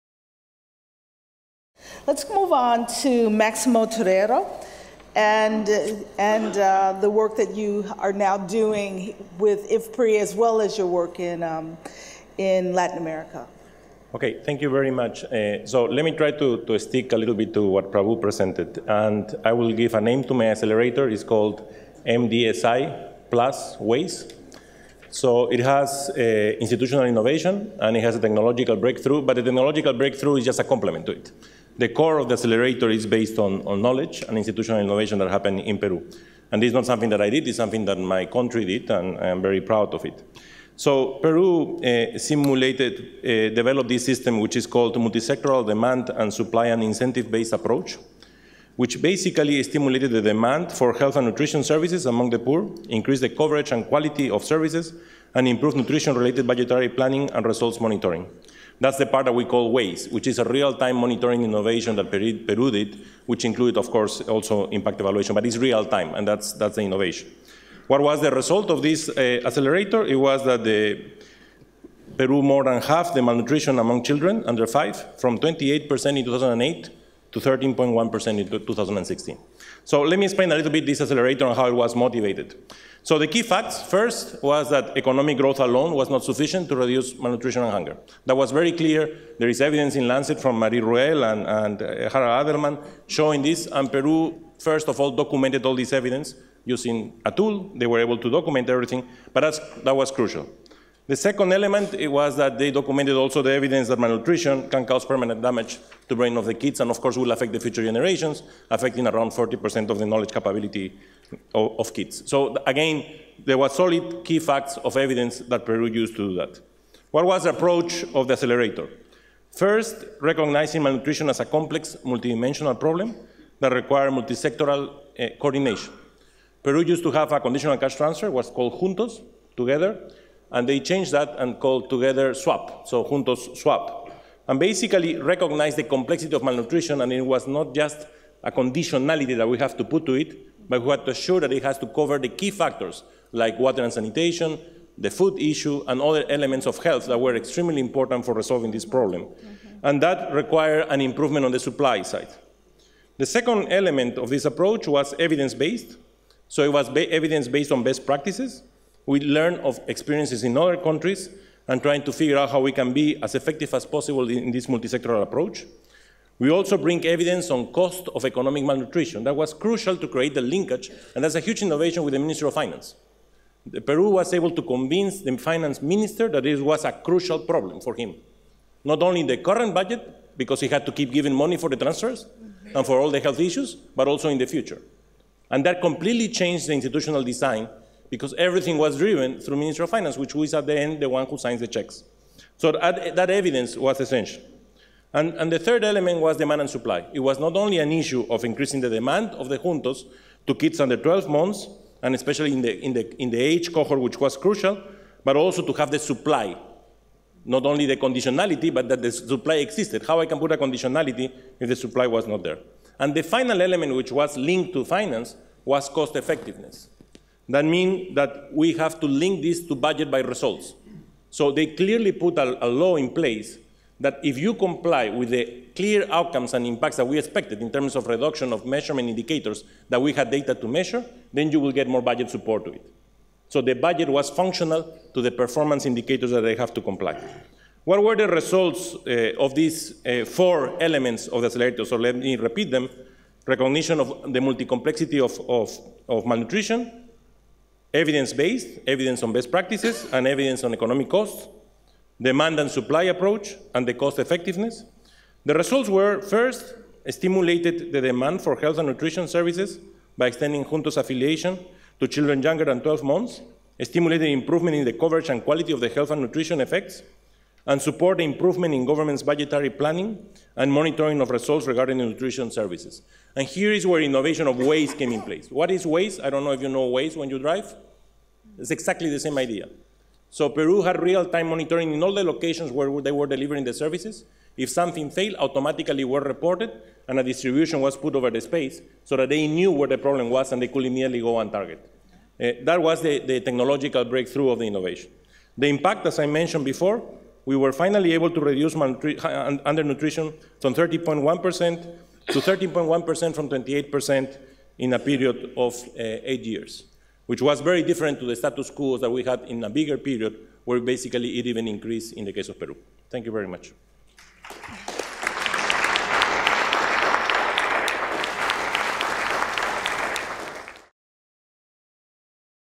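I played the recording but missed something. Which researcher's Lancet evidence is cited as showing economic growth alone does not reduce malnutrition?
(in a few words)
Marie Ruel.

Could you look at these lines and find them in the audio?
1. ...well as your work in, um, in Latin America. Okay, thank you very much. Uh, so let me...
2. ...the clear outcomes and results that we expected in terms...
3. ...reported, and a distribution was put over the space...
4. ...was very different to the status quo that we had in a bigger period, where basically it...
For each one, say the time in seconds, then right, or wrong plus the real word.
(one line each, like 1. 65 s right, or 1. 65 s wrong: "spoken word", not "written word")
1. 10 s right
2. 225 s wrong: "impacts", not "results"
3. 286 s right
4. 307 s right.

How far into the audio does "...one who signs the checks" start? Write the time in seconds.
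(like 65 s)
191 s.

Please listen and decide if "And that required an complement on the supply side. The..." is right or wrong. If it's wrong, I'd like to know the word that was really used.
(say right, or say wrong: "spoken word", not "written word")
wrong: "improvement", not "complement".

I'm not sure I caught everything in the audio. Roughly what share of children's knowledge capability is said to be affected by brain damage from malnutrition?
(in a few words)
40%.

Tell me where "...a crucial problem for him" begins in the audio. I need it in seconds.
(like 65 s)
176 s.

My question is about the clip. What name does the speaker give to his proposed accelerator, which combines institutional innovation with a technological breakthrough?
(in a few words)
MDSI Plus Waze.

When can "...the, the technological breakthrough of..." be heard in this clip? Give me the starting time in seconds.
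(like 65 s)
293 s.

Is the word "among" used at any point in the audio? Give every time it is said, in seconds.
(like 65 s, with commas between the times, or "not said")
52 s, 73 s.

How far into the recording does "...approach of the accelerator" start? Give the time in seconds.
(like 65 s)
117 s.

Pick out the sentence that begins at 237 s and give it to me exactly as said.
What were the results uh, of these uh, four elements of the accelerator?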